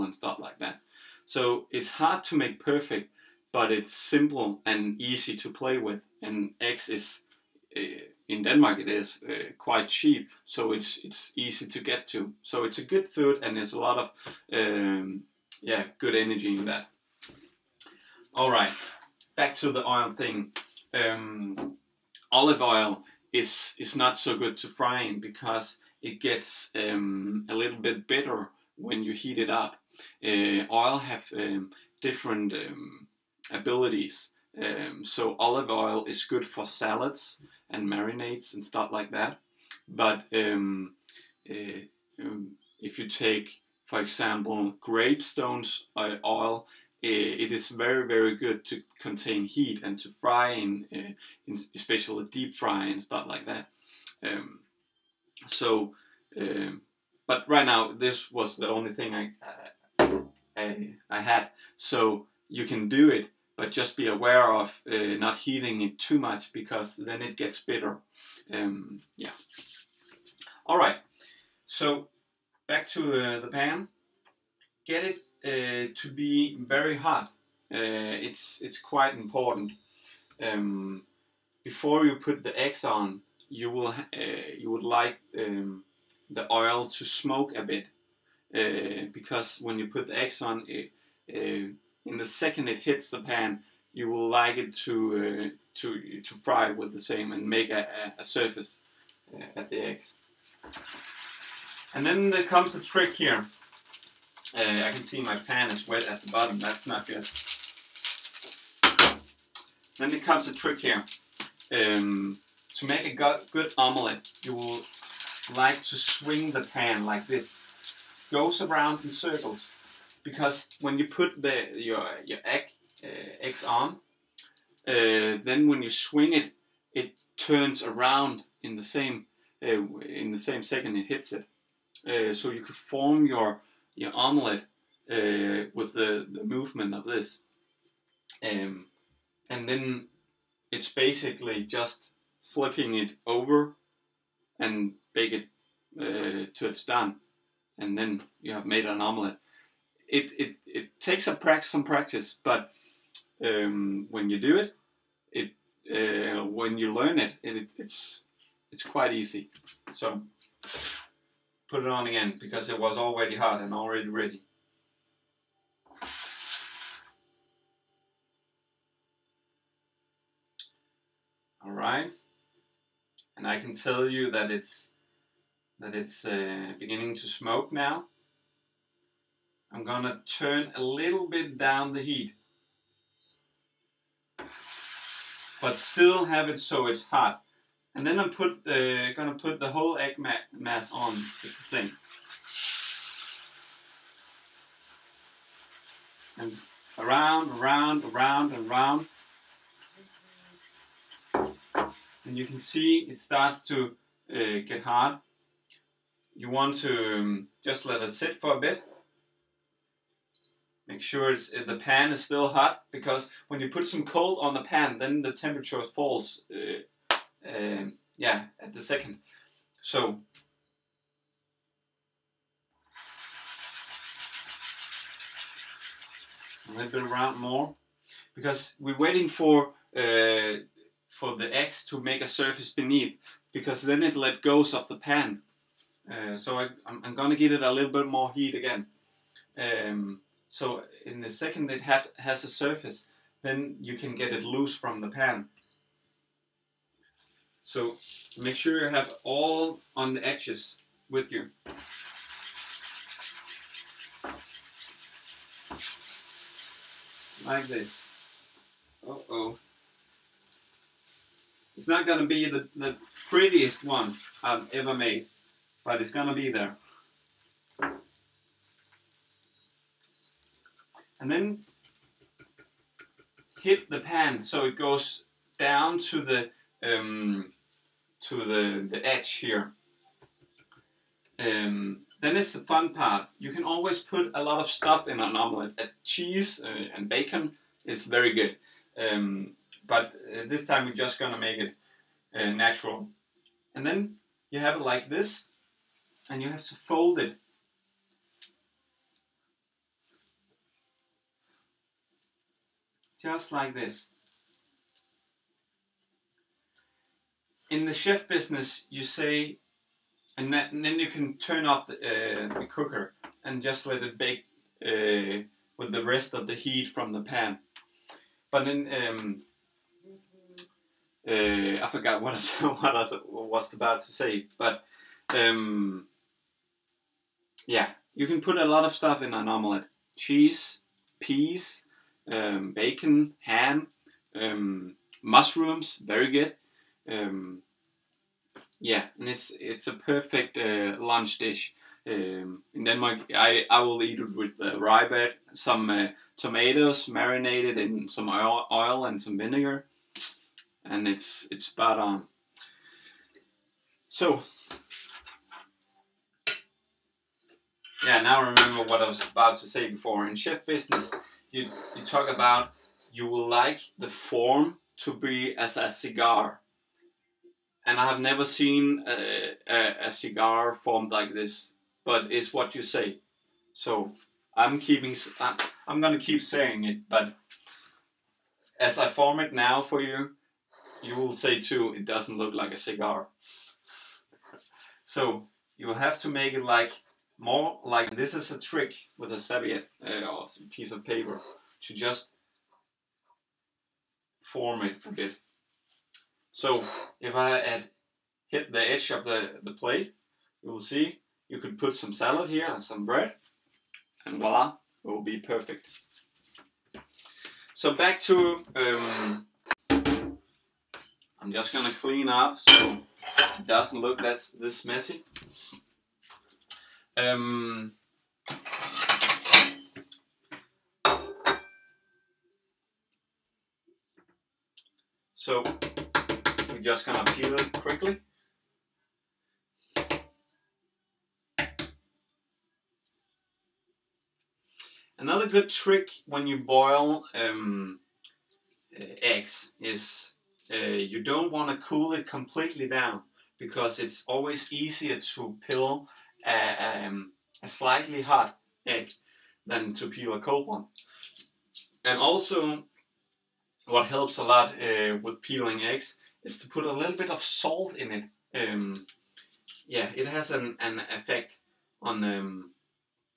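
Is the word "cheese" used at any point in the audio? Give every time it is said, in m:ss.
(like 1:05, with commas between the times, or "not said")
4:46, 5:30.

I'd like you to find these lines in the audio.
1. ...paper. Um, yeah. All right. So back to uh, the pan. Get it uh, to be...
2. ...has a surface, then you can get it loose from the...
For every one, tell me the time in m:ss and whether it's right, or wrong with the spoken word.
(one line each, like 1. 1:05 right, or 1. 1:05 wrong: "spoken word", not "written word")
1. 1:07 wrong: "bitter", not "paper"
2. 4:02 right.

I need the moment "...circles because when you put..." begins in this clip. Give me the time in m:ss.
1:59.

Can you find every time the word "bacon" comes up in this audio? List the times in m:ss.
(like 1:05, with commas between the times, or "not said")
4:47, 5:32.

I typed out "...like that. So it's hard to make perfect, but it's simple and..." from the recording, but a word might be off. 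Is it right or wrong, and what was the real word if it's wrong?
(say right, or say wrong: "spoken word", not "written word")
right.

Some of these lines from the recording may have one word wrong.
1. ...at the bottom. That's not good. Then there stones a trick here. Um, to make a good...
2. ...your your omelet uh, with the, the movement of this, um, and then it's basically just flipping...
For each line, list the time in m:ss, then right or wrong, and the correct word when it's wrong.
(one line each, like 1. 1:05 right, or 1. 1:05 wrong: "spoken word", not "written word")
1. 1:46 wrong: "comes", not "stones"
2. 2:13 right.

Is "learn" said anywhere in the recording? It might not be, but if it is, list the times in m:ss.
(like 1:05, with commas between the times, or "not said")
2:36.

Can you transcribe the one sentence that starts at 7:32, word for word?
And also, what helps a lot uh, with peeling eggs is to put a little bit of salt in it.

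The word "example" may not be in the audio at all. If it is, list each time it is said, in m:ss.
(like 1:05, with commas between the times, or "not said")
0:44.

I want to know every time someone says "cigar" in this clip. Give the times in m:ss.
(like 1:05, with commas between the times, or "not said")
6:05, 6:10, 6:22.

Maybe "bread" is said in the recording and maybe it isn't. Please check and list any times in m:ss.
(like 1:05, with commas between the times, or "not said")
5:45, 6:43.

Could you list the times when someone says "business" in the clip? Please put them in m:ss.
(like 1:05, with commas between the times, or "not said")
5:08, 6:00.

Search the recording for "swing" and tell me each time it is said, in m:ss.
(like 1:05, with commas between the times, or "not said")
1:55, 2:05.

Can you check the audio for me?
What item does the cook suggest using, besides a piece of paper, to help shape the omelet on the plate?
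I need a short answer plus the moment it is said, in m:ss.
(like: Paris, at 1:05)
a serviette, at 6:29.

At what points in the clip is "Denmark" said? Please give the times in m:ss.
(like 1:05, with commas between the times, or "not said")
0:08, 5:42.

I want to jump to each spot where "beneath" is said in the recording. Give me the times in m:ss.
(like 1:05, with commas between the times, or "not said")
3:52.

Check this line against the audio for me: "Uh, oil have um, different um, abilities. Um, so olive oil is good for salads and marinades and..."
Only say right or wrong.
right.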